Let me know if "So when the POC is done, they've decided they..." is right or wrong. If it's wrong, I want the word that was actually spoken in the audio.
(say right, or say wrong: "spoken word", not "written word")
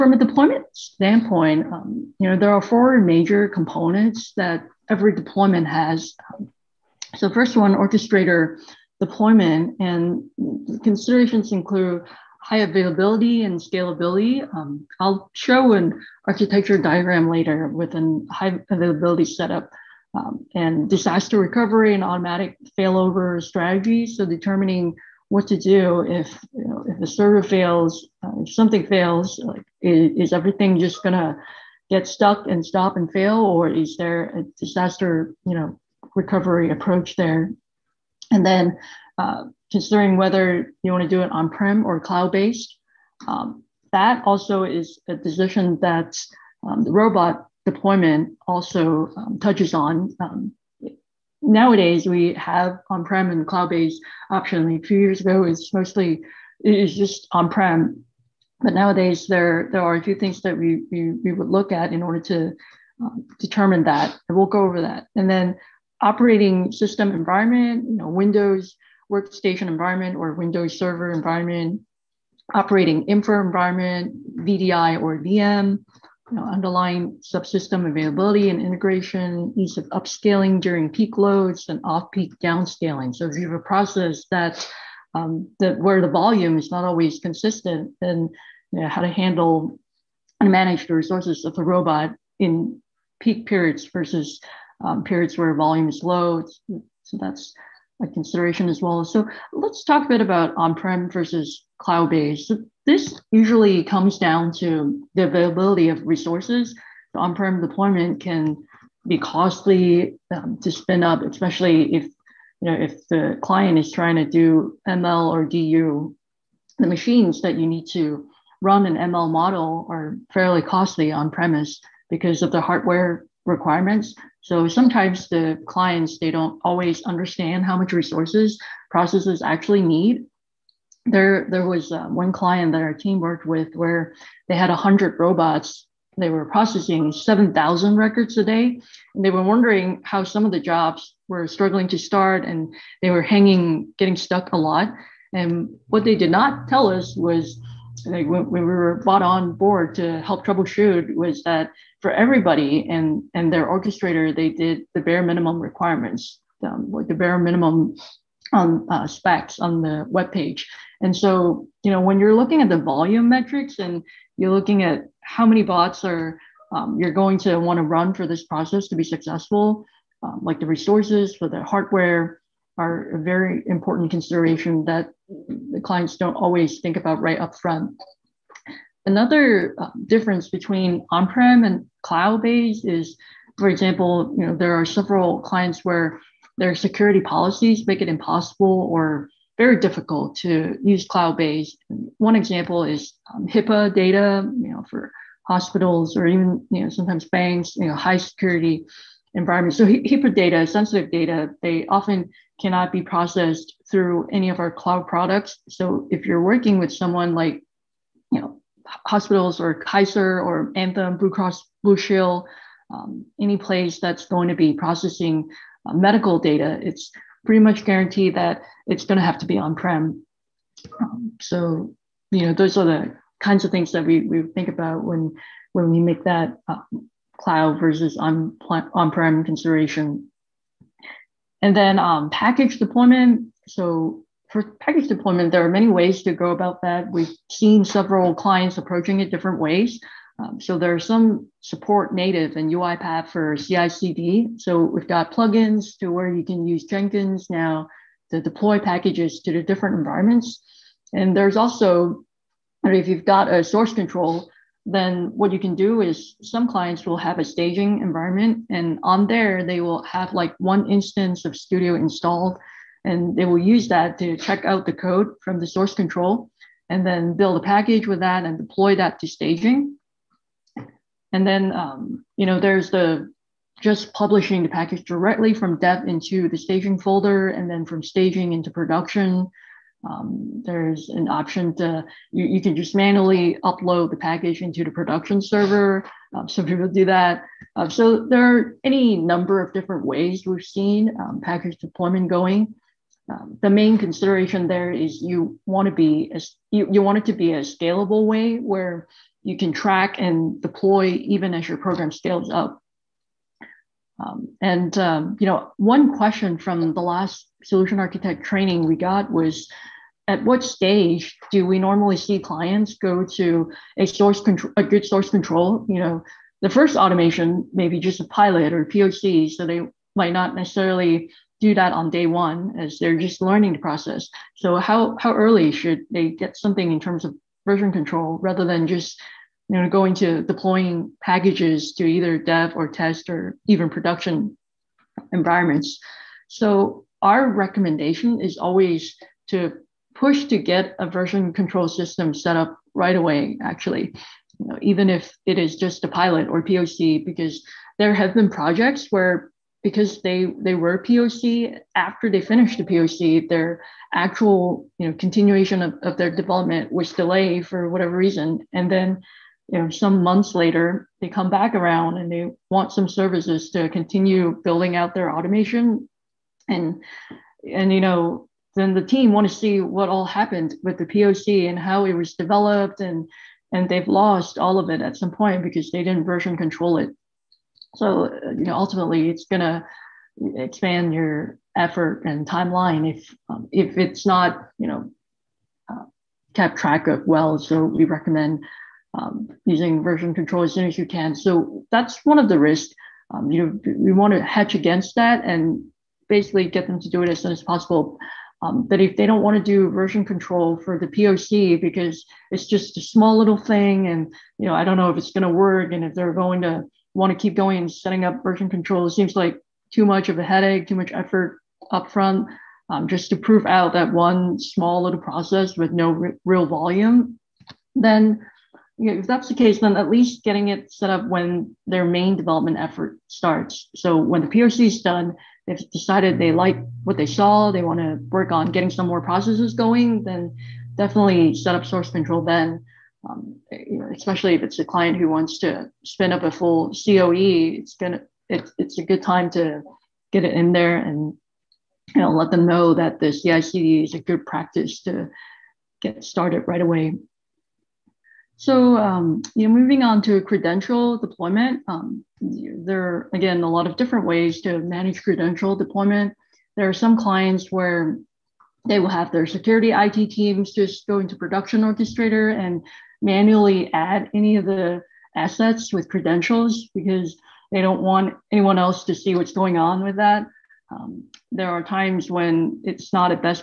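right.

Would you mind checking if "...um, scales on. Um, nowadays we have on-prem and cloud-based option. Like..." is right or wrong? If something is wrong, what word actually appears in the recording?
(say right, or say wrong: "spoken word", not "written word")
wrong: "touches", not "scales".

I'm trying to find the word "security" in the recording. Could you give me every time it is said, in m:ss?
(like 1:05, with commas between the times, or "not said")
3:06, 3:18, 7:39.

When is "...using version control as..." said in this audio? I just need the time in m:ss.
6:29.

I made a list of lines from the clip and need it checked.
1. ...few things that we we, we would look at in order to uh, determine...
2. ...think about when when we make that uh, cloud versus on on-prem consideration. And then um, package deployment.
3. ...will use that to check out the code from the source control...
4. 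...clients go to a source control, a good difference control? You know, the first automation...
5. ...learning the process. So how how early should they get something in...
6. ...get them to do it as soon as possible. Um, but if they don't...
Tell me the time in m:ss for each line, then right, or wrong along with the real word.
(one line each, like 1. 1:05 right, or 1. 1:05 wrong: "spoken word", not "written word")
1. 1:00 right
2. 3:44 right
3. 4:23 right
4. 5:12 wrong: "source", not "difference"
5. 5:23 right
6. 6:36 right.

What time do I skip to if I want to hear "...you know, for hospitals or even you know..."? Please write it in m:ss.
3:14.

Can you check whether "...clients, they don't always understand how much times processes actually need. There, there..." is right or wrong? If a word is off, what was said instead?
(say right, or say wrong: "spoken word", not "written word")
wrong: "resources", not "times".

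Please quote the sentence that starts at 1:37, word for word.
So that's a consideration as well.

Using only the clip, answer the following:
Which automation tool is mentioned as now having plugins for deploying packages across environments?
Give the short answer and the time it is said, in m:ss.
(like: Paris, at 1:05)
Jenkins, at 4:06.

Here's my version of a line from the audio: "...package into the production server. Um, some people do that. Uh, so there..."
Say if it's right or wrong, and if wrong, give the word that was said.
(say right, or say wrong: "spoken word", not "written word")
right.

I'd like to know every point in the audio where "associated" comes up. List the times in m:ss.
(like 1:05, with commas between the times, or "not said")
not said.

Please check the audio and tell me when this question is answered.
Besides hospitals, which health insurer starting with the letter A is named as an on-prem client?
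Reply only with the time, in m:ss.
3:30.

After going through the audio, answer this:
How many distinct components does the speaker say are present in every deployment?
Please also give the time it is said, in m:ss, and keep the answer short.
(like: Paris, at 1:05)
4, at 0:02.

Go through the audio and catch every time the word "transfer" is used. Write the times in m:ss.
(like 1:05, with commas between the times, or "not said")
not said.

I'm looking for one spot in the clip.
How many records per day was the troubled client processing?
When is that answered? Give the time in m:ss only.
2:17.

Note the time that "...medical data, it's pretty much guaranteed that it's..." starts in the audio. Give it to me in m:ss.
3:35.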